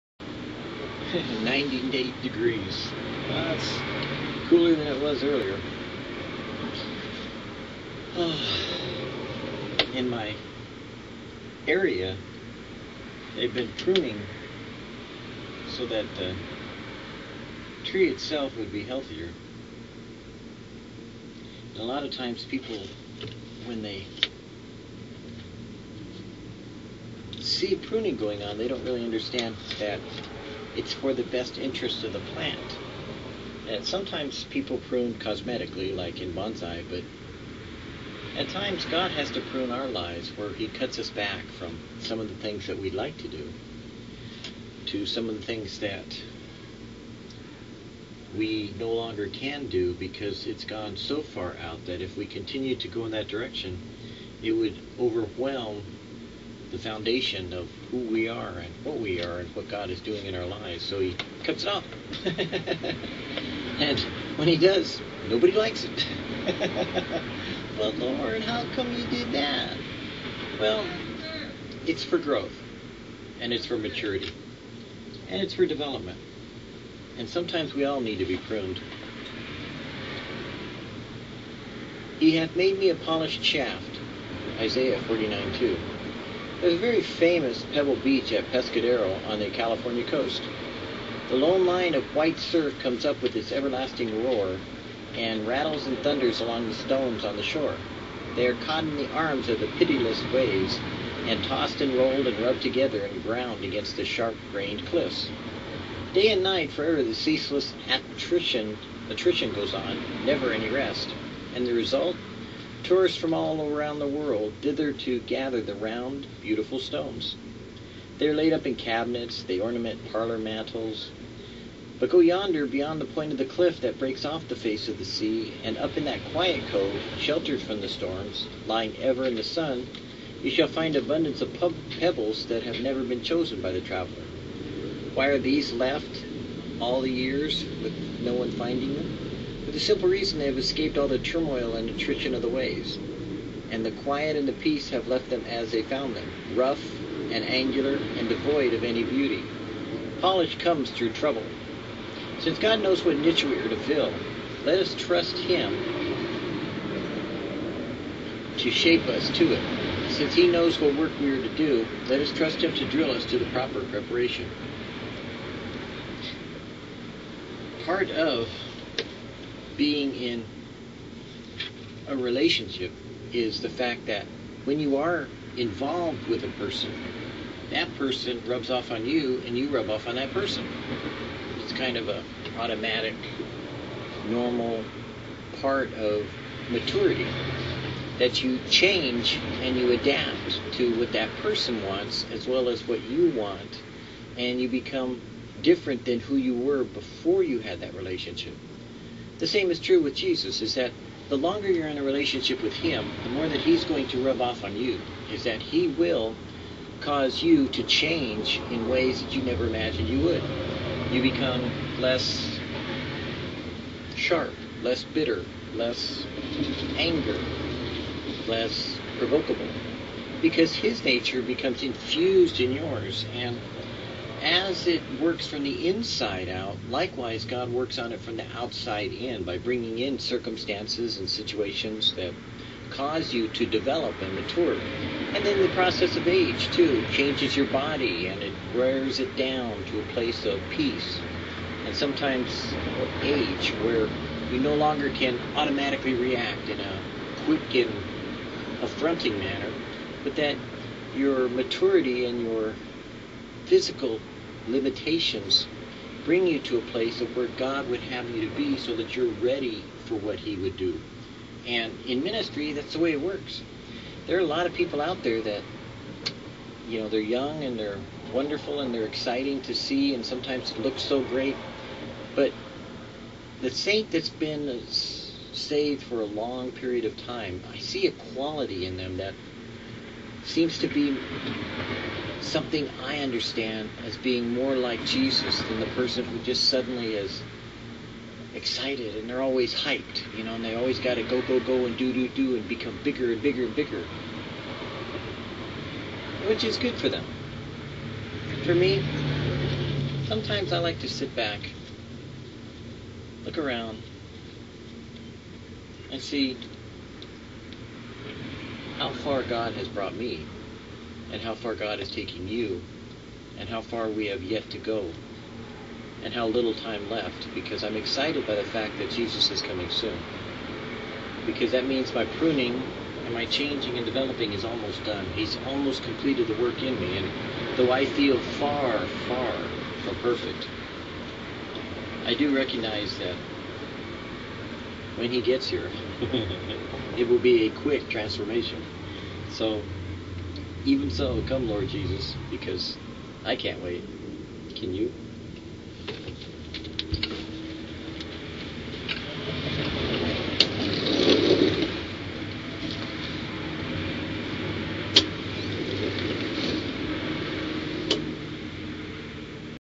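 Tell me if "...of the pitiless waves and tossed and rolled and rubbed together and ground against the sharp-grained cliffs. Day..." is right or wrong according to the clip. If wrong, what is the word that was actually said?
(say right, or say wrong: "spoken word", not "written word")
right.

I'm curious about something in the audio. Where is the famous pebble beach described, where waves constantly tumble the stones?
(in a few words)
Pescadero.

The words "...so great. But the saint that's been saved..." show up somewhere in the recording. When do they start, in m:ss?
4:31.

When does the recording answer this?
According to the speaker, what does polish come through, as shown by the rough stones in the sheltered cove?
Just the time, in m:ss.
2:31.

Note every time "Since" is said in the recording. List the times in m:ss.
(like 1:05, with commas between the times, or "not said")
2:32, 2:40.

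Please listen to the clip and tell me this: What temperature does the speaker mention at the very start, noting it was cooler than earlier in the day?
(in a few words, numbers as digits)
98 degrees.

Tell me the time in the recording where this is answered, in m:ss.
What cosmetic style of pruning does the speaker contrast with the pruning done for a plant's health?
0:36.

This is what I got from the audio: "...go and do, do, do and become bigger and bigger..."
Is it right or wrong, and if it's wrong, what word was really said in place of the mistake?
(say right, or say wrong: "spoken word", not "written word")
right.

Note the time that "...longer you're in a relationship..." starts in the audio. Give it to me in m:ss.
3:21.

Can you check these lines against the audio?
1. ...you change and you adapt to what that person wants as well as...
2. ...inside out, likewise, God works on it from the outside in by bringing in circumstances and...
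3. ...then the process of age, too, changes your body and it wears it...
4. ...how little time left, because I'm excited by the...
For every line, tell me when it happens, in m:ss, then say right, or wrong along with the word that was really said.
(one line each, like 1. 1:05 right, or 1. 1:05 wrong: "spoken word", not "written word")
1. 3:08 right
2. 3:45 right
3. 3:55 right
4. 5:16 right.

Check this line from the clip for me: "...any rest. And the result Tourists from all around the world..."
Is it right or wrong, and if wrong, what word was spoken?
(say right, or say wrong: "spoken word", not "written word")
right.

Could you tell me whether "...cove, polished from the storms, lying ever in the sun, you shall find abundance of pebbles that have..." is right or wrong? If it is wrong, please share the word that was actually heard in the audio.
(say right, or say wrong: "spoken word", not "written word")
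wrong: "sheltered", not "polished".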